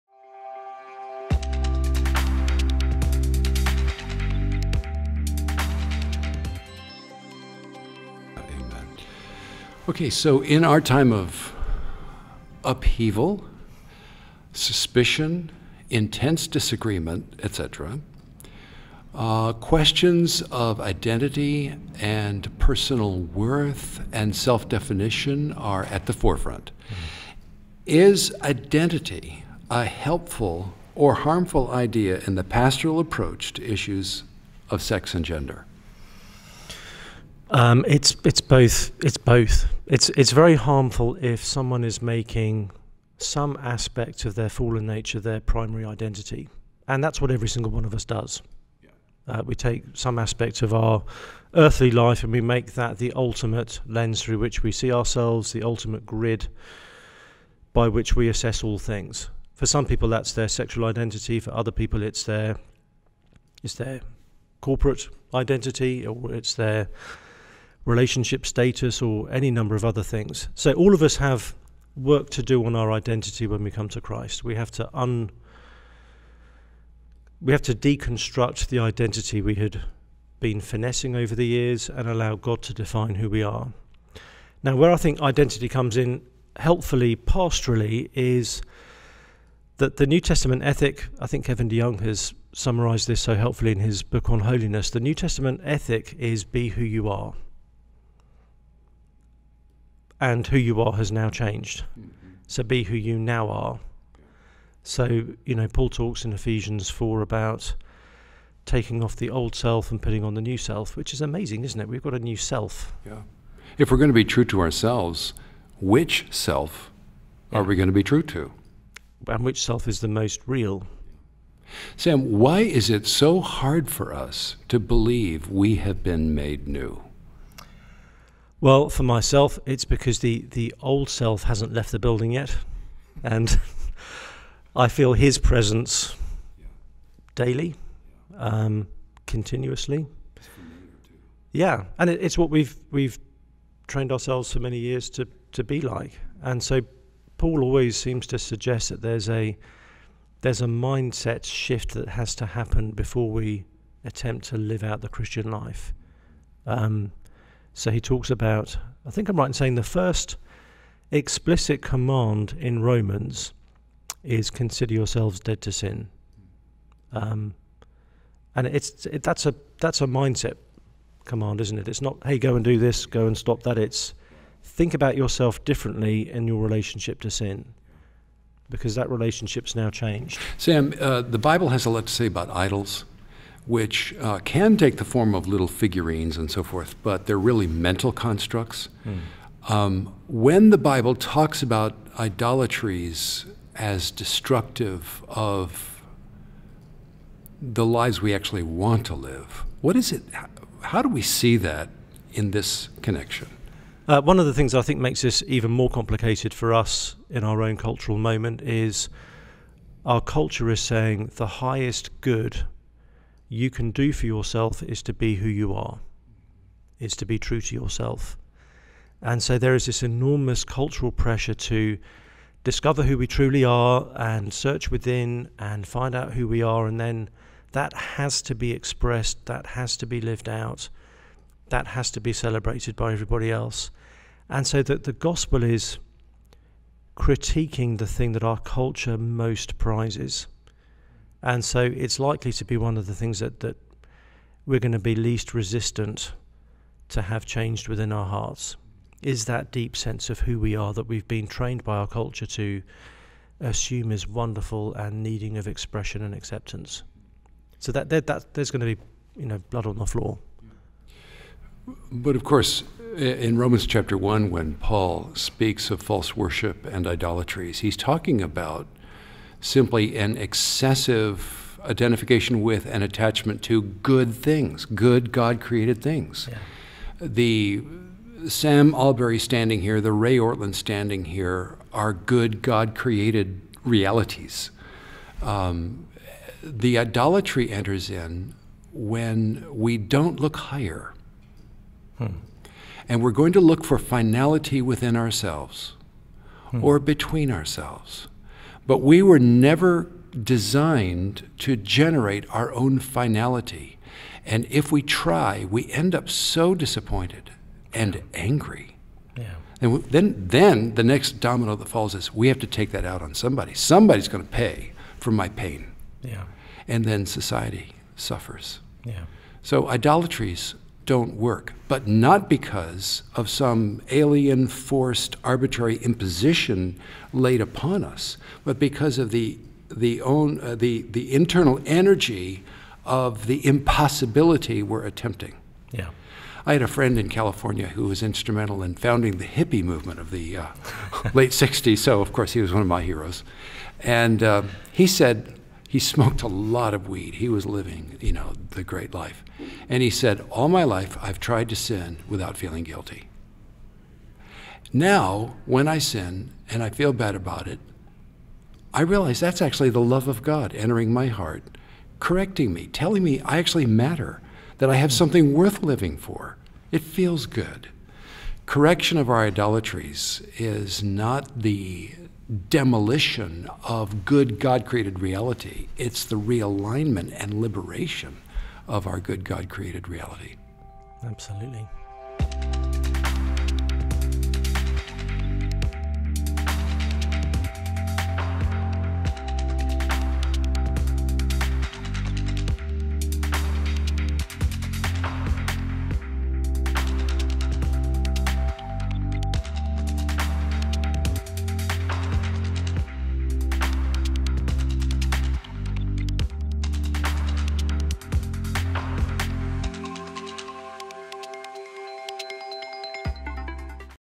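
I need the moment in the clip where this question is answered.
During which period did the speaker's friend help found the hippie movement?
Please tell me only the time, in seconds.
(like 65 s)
341 s.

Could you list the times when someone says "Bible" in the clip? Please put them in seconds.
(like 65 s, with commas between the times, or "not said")
181 s, 190 s.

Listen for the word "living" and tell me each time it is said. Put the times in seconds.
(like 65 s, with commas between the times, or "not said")
347 s, 365 s.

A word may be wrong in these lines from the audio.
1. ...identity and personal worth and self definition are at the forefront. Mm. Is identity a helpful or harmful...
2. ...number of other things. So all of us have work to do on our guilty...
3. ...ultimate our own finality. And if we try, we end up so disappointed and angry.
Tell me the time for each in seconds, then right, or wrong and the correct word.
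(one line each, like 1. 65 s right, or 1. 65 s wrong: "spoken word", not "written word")
1. 20 s right
2. 69 s wrong: "identity", not "guilty"
3. 301 s wrong: "generate", not "ultimate".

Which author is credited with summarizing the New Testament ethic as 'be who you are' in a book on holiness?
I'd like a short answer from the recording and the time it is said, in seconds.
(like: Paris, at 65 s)
Kevin DeYoung, at 91 s.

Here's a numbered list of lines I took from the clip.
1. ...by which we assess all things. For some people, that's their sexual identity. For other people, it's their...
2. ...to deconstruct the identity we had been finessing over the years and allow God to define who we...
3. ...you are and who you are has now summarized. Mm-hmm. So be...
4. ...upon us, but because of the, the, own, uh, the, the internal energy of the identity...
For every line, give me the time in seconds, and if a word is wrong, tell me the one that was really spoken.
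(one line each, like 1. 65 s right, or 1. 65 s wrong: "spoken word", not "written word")
1. 57 s right
2. 77 s right
3. 96 s wrong: "changed", not "summarized"
4. 327 s wrong: "impossibility", not "identity".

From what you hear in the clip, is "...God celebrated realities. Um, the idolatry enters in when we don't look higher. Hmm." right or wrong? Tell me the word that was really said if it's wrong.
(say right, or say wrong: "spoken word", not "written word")
wrong: "created", not "celebrated".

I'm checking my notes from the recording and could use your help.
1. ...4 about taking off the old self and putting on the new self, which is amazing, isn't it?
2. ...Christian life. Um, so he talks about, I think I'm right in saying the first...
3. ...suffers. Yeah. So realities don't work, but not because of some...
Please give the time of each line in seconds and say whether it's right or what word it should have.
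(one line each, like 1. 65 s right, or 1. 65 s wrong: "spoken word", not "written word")
1. 106 s right
2. 155 s right
3. 318 s wrong: "idolatries", not "realities".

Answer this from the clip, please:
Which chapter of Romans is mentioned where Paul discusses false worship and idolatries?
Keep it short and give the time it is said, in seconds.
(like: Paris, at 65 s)
Chapter 1, at 263 s.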